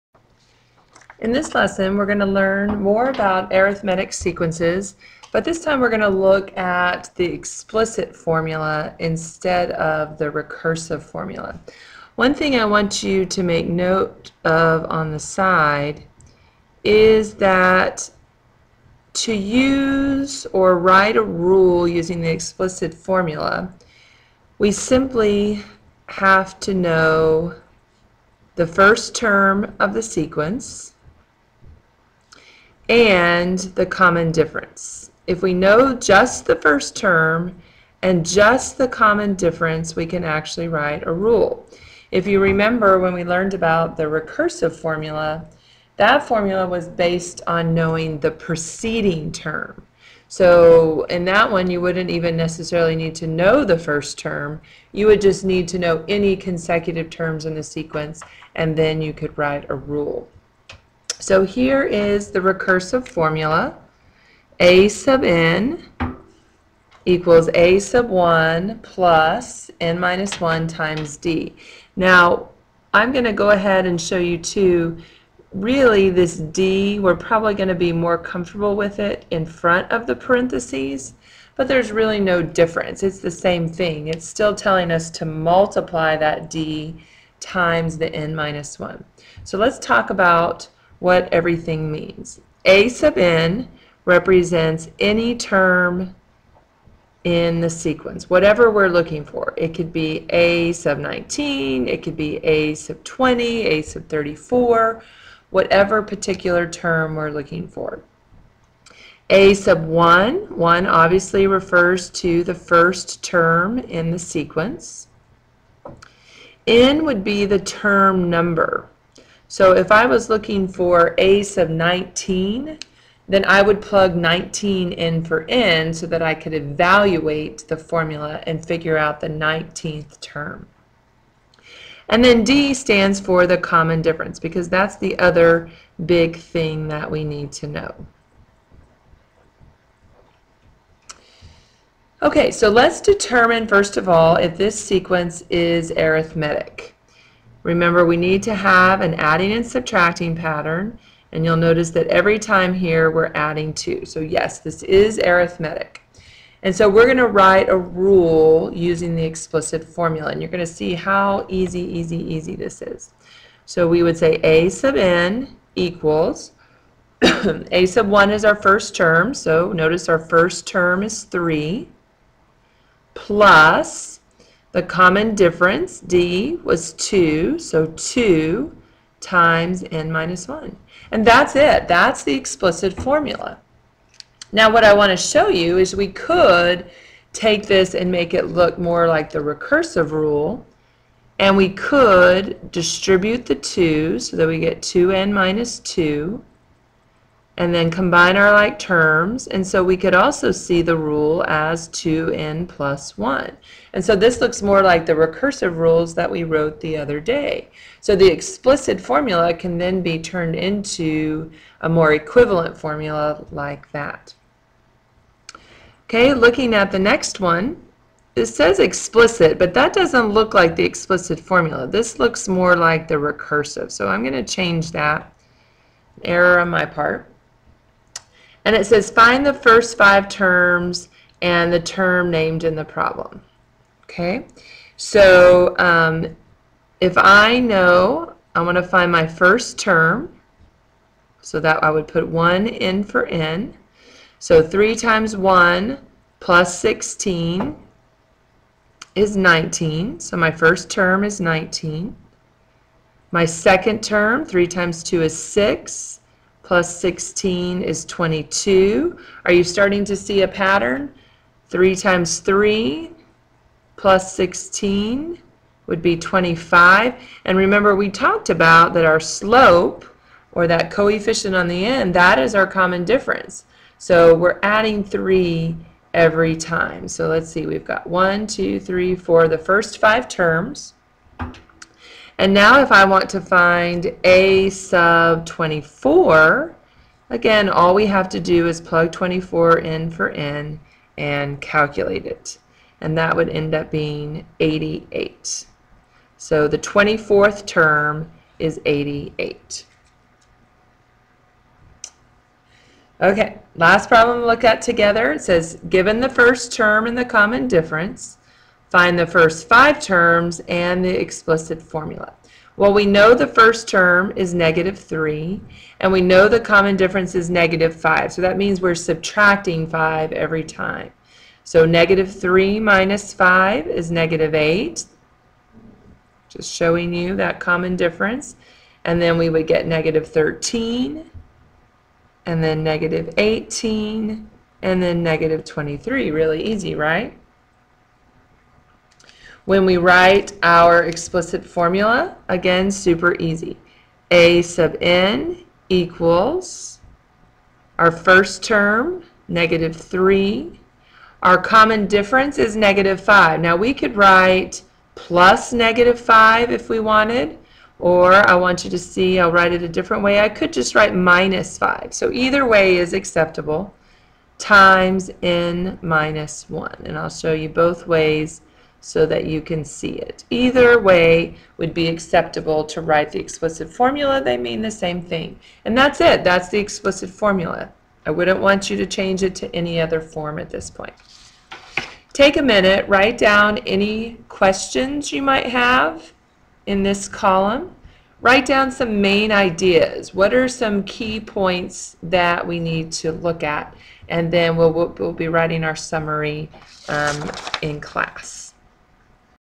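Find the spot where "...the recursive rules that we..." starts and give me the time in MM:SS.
03:25.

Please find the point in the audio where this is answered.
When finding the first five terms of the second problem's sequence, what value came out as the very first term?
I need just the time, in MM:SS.
04:10.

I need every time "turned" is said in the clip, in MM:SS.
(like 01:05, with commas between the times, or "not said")
03:30.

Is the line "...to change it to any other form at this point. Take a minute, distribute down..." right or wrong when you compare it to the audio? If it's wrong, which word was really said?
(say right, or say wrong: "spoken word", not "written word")
wrong: "write", not "distribute".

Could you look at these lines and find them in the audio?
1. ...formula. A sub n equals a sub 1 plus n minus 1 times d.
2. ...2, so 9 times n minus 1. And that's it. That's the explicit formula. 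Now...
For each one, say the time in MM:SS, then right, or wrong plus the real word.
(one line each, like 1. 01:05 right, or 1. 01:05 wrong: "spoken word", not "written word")
1. 01:03 right
2. 02:56 wrong: "2", not "9".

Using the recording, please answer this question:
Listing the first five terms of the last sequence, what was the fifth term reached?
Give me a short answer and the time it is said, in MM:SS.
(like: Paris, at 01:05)
-23, at 05:35.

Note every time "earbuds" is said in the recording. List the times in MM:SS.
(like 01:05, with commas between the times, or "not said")
not said.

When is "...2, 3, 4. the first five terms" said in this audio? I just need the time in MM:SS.
04:38.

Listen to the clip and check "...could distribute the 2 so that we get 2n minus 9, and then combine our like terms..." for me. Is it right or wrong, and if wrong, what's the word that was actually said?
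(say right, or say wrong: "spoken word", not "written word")
wrong: "2", not "9".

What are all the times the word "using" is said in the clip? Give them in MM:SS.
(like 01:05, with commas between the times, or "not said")
00:21, 02:38.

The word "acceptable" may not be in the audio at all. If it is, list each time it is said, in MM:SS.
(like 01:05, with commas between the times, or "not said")
06:03, 06:12.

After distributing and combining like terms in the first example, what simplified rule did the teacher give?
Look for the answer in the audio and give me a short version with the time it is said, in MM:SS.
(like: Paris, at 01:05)
2n plus 1, at 03:21.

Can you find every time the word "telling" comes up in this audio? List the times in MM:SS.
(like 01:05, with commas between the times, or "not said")
01:24.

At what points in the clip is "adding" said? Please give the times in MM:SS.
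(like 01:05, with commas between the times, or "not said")
02:29, 02:33, 04:34.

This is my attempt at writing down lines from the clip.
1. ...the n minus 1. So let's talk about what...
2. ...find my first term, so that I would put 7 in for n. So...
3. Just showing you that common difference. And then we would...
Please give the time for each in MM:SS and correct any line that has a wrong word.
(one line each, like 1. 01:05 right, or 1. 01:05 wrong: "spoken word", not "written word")
1. 01:27 right
2. 03:58 wrong: "1", not "7"
3. 05:26 right.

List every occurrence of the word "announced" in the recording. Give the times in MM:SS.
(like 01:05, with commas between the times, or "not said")
not said.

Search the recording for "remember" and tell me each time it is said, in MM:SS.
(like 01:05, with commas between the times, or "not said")
00:42, 02:27, 04:27.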